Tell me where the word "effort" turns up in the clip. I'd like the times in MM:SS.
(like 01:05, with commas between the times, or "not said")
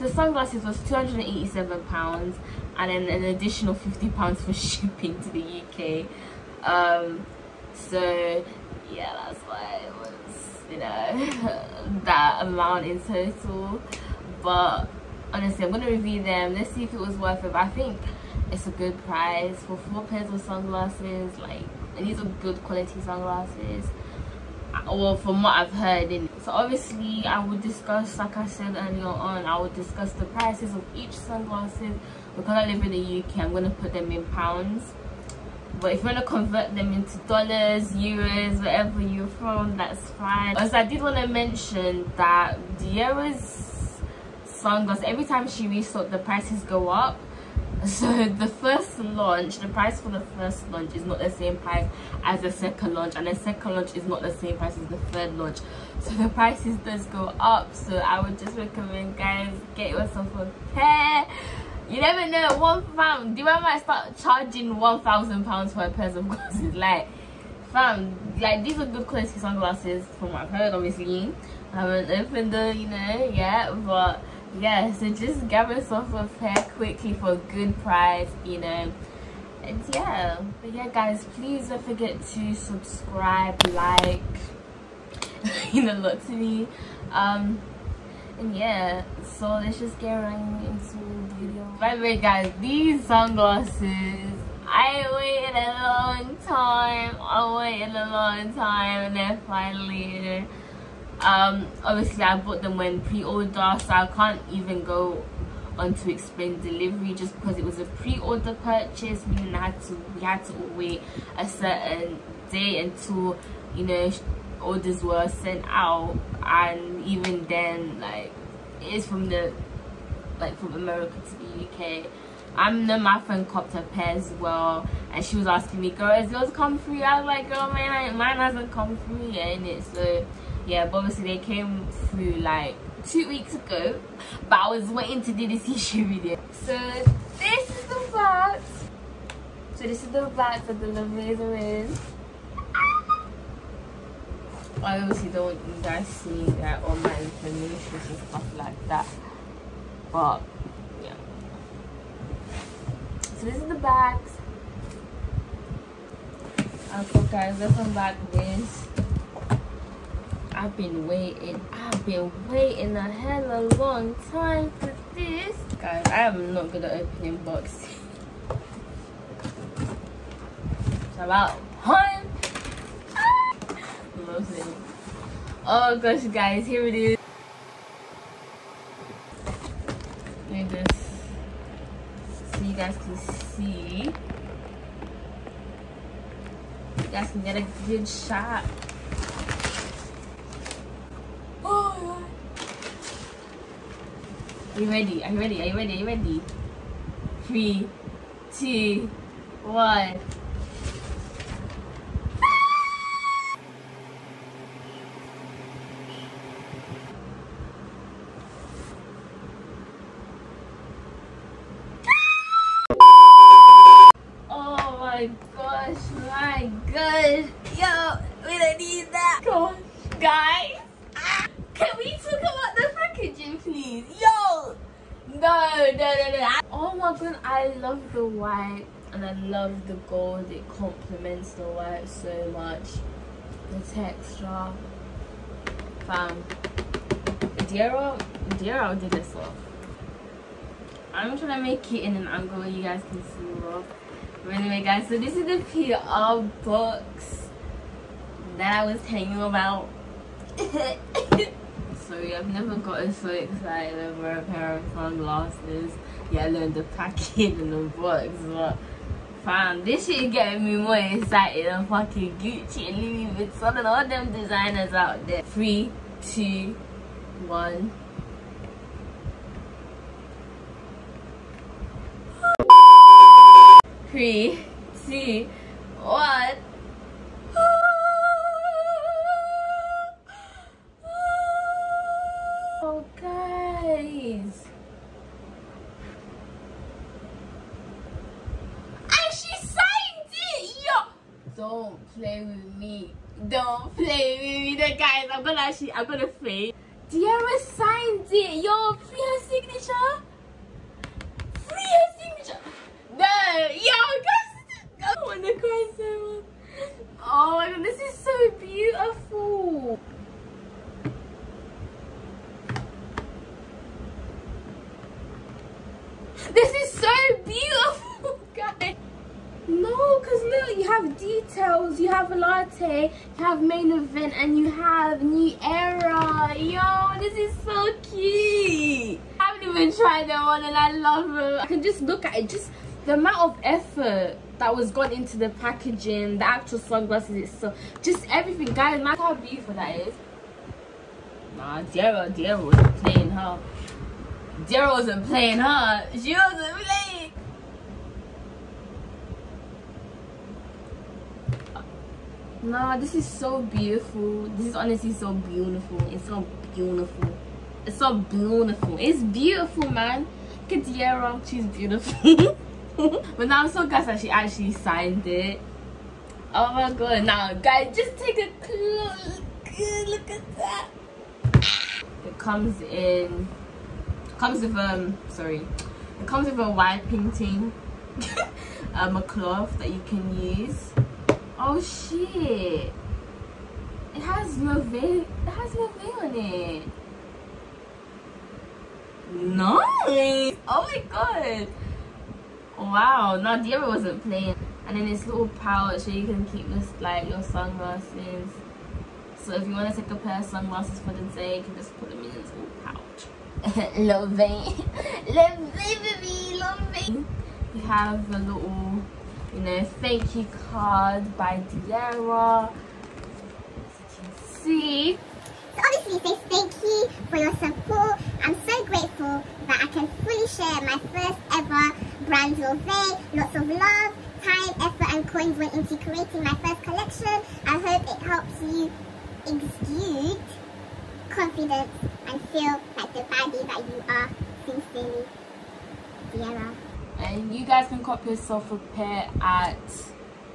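05:33, 07:04.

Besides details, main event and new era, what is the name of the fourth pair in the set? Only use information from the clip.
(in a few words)
latte.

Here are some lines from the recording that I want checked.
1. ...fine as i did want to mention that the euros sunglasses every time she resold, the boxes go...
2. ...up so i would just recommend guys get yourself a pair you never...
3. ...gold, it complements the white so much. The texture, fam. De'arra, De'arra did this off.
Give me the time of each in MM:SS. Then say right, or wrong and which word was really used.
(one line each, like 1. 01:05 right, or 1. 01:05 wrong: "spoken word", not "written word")
1. 00:40 wrong: "prices", not "boxes"
2. 00:57 right
3. 03:50 right.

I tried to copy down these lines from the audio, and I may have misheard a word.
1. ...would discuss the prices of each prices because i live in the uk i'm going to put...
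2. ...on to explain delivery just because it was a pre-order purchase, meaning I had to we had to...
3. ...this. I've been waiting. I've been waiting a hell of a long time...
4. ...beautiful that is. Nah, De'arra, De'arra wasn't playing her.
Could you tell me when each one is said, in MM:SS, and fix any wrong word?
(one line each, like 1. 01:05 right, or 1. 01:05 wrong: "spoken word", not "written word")
1. 00:29 wrong: "sunglasses", not "prices"
2. 01:45 right
3. 02:38 right
4. 05:39 right.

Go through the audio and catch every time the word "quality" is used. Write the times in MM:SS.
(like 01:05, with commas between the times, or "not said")
00:22, 01:09.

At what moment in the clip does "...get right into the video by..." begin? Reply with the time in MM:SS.
01:29.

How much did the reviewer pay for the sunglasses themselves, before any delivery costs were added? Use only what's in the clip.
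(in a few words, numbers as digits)
£287.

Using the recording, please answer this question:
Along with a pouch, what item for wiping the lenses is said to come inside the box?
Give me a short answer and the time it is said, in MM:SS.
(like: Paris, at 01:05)
a cloth, at 06:19.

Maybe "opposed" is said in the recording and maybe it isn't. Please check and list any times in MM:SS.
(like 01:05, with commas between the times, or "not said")
not said.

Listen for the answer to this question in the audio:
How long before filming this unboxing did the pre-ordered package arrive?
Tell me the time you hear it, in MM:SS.
02:13.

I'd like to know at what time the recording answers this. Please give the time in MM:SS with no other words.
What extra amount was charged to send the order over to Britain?
00:03.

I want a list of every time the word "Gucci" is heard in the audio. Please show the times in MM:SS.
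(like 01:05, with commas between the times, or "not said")
04:22.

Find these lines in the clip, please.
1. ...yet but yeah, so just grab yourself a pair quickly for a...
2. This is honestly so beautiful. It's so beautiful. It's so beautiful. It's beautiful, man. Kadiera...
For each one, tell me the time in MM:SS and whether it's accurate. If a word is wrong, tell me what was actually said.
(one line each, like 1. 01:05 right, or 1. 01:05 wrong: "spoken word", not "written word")
1. 01:13 right
2. 05:54 right.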